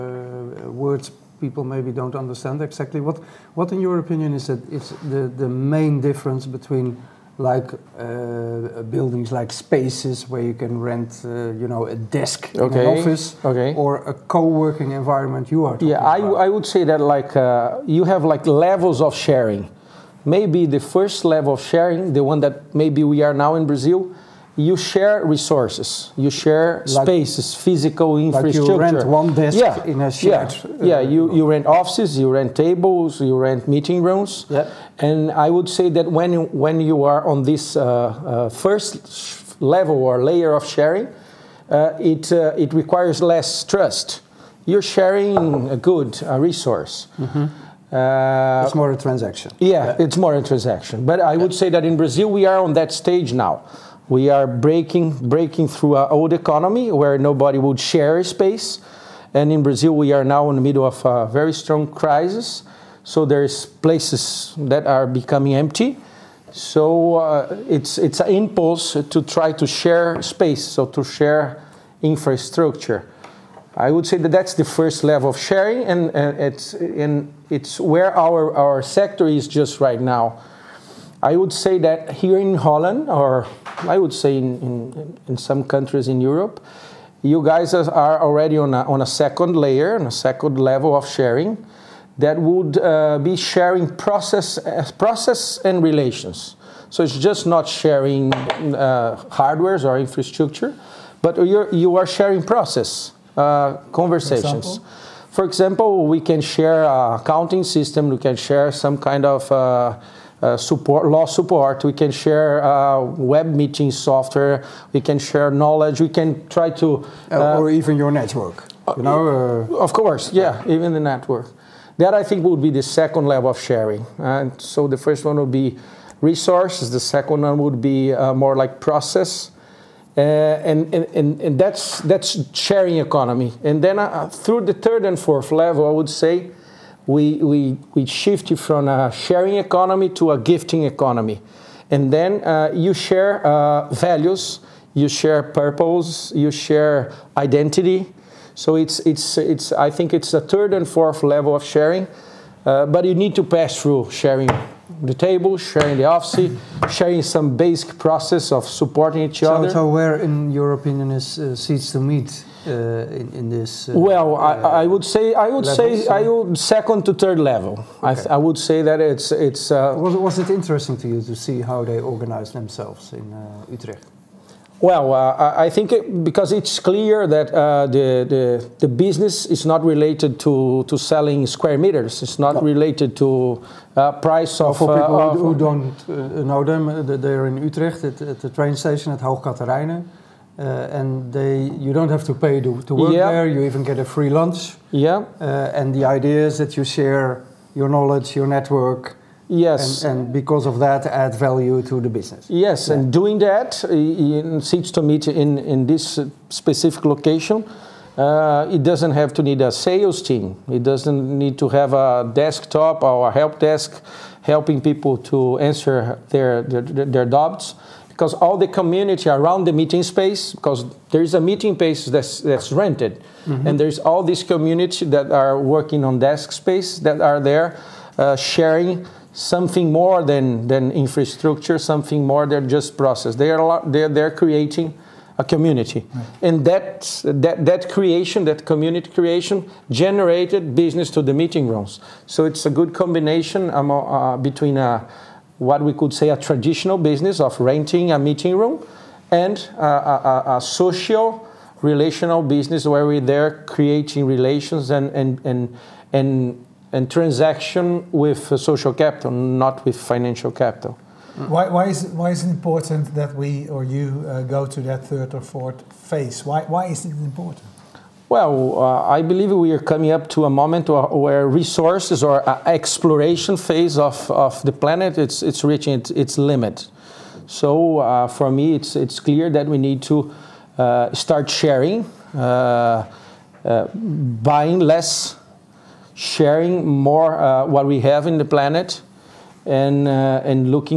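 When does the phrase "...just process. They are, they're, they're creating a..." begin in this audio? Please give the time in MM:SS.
03:52.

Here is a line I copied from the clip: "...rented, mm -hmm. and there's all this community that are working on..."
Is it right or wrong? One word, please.
right.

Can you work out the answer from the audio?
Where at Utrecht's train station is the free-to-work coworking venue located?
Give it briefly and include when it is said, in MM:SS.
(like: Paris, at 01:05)
Hoog Catharijne, at 03:09.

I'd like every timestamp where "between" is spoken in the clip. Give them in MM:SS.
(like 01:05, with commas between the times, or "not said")
00:06, 04:04.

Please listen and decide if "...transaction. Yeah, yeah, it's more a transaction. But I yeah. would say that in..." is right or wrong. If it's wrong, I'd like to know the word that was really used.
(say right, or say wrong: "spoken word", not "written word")
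right.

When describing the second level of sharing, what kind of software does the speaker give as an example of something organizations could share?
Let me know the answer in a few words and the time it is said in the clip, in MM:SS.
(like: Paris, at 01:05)
Web meeting software, at 01:53.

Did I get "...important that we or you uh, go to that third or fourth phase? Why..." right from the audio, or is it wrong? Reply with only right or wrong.
right.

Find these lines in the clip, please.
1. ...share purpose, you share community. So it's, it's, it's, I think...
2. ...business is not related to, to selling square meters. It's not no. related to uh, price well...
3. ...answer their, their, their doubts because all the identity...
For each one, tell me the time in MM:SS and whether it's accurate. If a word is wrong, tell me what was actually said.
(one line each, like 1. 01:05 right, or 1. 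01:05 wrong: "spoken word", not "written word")
1. 02:25 wrong: "identity", not "community"
2. 02:58 right
3. 03:35 wrong: "community", not "identity".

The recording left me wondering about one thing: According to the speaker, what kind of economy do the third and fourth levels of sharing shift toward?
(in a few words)
A gifting economy.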